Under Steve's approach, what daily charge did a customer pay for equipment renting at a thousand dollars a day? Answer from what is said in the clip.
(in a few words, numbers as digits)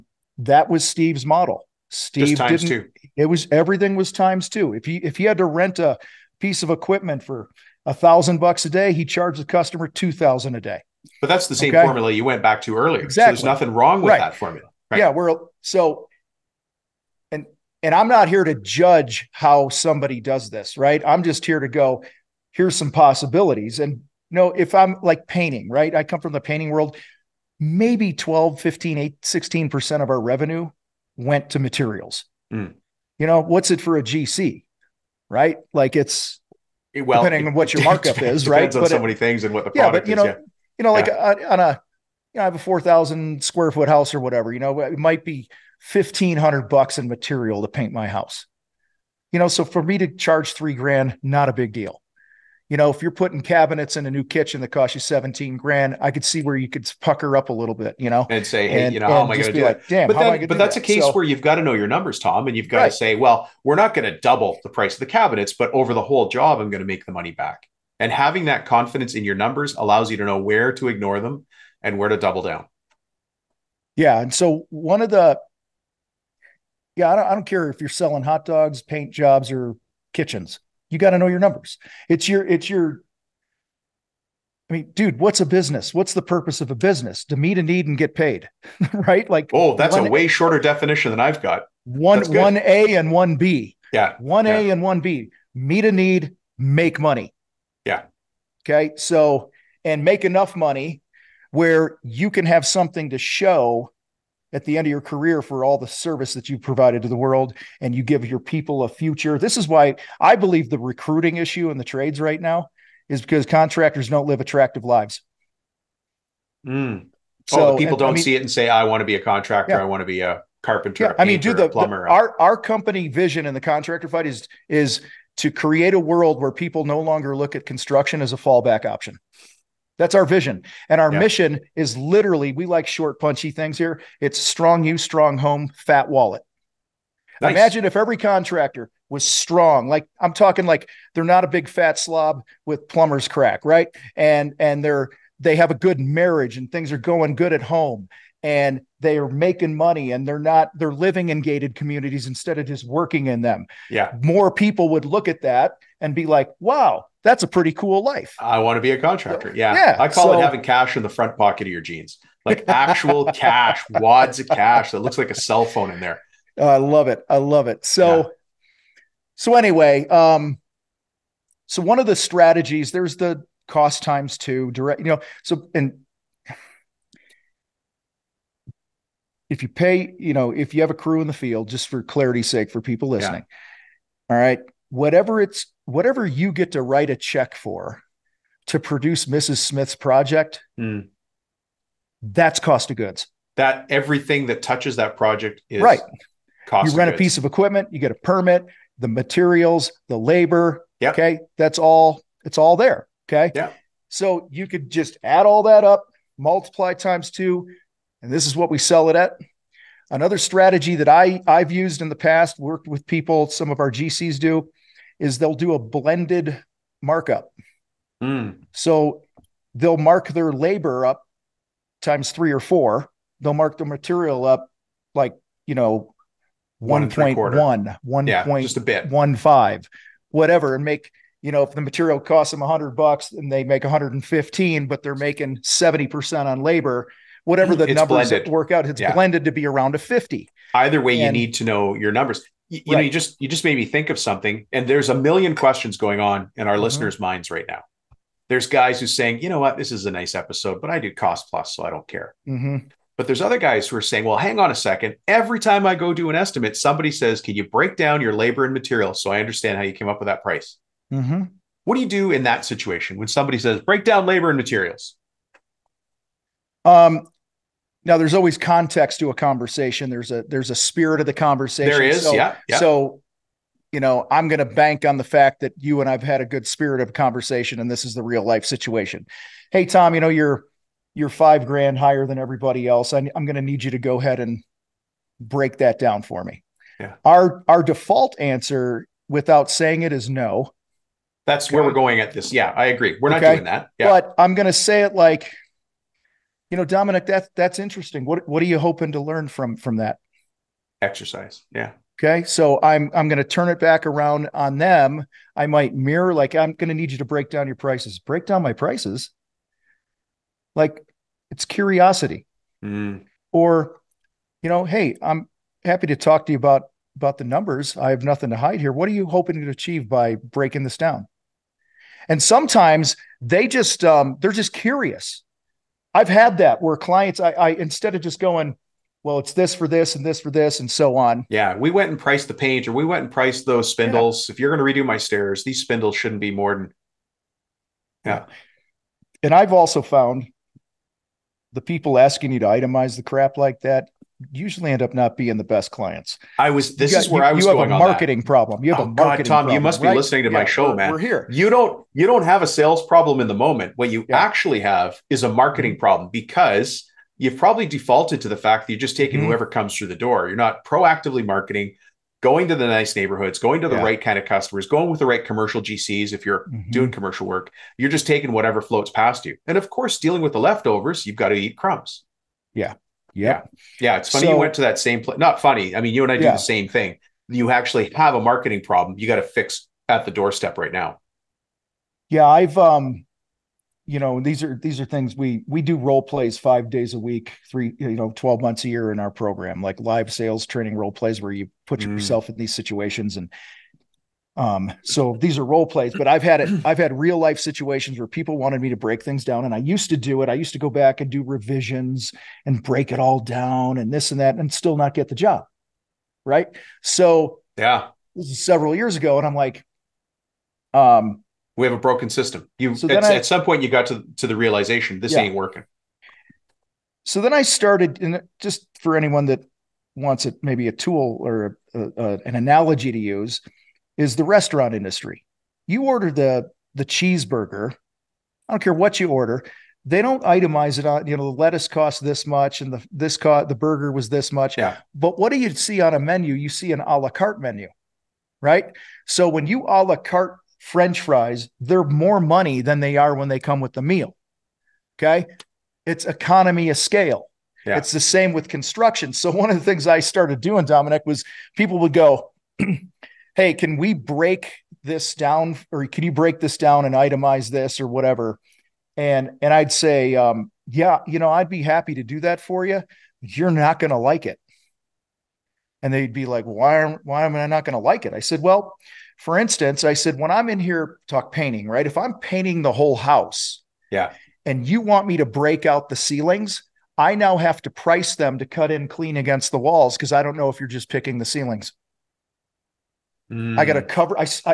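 2,000.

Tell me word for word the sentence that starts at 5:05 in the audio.
I might mirror like I'm going to need you to break down your prices.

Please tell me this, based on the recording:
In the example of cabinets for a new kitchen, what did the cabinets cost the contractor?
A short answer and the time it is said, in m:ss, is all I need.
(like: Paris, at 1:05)
17,000, at 0:54.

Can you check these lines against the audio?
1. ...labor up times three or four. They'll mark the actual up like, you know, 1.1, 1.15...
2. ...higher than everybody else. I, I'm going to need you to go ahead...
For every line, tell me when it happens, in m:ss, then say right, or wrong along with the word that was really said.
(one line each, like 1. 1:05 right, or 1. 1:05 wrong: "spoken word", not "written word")
1. 3:40 wrong: "material", not "actual"
2. 4:41 right.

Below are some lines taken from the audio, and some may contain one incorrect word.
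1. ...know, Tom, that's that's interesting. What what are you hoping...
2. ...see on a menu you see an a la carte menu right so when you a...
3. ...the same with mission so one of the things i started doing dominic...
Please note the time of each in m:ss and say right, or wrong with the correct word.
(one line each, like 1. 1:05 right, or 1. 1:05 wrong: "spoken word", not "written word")
1. 4:56 wrong: "Dominic", not "Tom"
2. 7:15 right
3. 7:28 wrong: "construction", not "mission".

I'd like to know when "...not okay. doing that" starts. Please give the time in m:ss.
4:53.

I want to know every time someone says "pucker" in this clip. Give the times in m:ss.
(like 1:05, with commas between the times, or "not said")
0:56.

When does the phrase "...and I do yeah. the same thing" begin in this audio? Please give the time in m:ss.
6:16.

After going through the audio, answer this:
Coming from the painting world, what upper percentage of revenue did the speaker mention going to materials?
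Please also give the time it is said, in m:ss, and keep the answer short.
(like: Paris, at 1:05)
16%, at 0:29.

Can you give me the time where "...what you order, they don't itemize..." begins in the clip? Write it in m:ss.
7:08.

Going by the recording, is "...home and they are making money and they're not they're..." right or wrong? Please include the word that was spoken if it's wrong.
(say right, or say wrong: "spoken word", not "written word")
right.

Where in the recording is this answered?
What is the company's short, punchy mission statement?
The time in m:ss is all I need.
2:14.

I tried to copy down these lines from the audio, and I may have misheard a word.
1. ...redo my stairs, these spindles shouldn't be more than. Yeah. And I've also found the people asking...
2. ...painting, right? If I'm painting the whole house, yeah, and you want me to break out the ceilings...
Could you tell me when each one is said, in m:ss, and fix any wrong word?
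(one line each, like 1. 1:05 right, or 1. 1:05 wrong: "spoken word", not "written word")
1. 5:34 right
2. 7:51 right.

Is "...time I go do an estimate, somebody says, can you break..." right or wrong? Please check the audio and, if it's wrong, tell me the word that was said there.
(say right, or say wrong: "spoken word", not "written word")
right.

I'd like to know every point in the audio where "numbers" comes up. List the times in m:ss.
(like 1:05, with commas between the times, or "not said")
1:01, 1:09, 1:21, 3:57, 4:02, 5:17.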